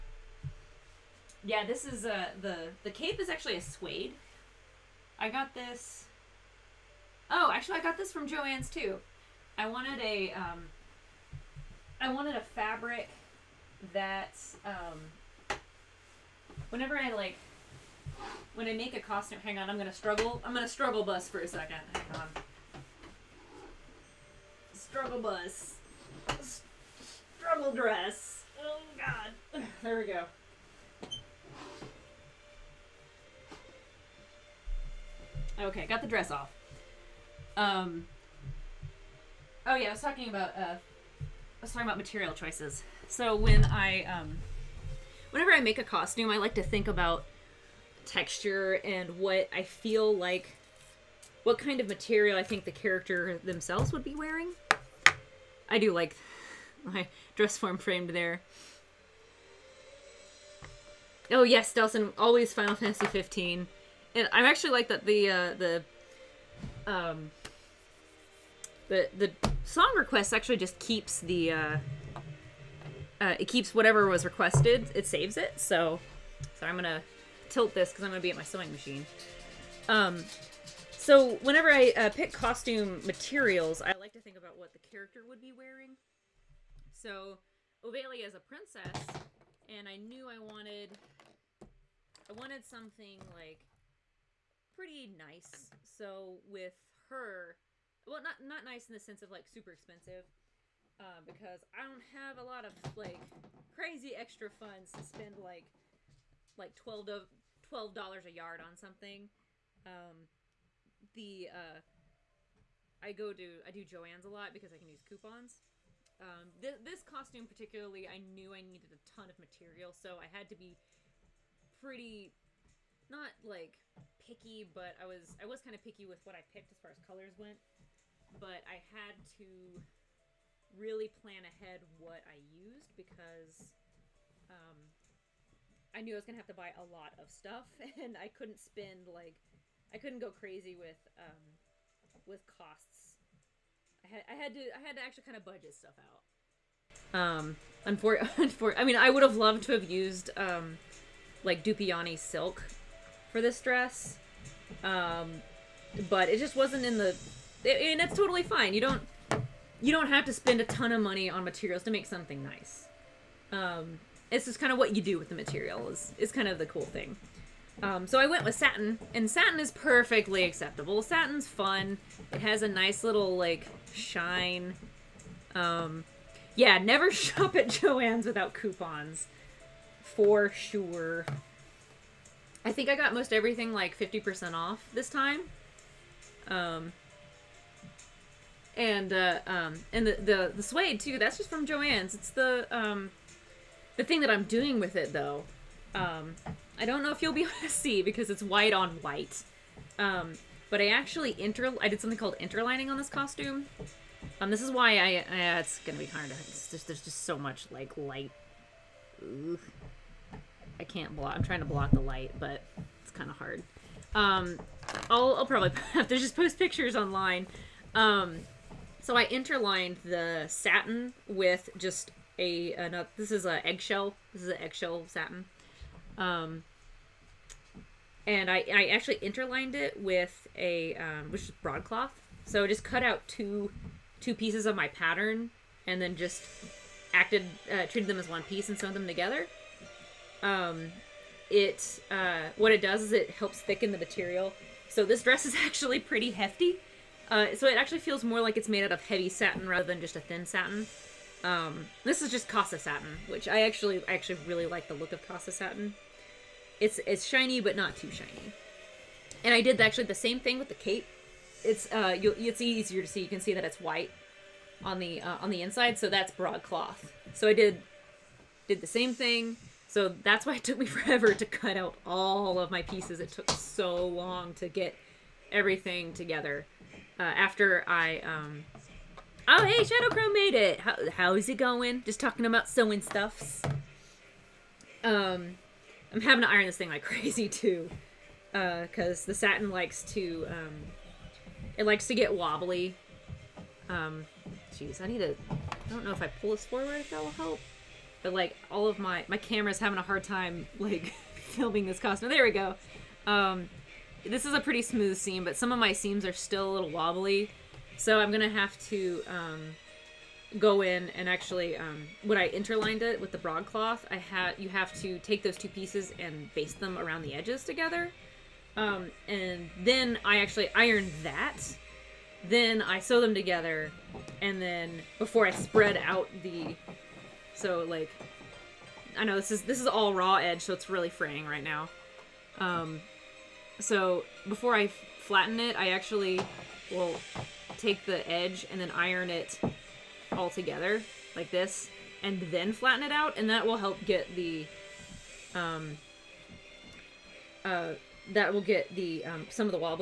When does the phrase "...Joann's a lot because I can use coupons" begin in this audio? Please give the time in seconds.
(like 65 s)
113 s.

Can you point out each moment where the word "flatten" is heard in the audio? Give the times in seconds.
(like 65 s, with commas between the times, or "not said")
334 s, 342 s.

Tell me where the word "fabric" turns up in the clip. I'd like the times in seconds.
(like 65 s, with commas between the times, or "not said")
12 s.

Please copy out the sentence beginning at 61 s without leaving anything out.
Oh yes, Delson, always Final Fantasy 15.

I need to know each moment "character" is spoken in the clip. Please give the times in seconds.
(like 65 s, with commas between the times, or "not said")
52 s, 84 s.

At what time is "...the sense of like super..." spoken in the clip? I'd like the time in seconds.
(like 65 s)
98 s.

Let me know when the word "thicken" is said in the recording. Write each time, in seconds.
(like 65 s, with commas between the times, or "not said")
243 s.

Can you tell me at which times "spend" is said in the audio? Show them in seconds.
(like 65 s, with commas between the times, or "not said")
105 s, 138 s, 160 s.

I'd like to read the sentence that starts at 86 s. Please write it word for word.
So Ovelia is a princess, and I knew I wanted I wanted something like pretty nice.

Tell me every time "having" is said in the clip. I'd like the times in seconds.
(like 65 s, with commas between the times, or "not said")
286 s, 299 s.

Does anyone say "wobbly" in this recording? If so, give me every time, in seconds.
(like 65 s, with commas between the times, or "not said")
292 s, 306 s.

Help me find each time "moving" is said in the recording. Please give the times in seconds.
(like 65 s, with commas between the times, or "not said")
not said.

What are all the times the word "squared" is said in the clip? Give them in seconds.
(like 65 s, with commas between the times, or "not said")
not said.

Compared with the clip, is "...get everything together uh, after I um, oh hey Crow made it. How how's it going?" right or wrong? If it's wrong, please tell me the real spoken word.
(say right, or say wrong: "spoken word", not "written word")
right.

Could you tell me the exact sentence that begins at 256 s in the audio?
It's it's shiny but not too shiny.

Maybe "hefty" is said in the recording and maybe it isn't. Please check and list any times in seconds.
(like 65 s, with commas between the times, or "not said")
246 s.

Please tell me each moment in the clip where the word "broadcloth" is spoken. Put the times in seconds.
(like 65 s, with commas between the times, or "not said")
231 s, 266 s, 313 s.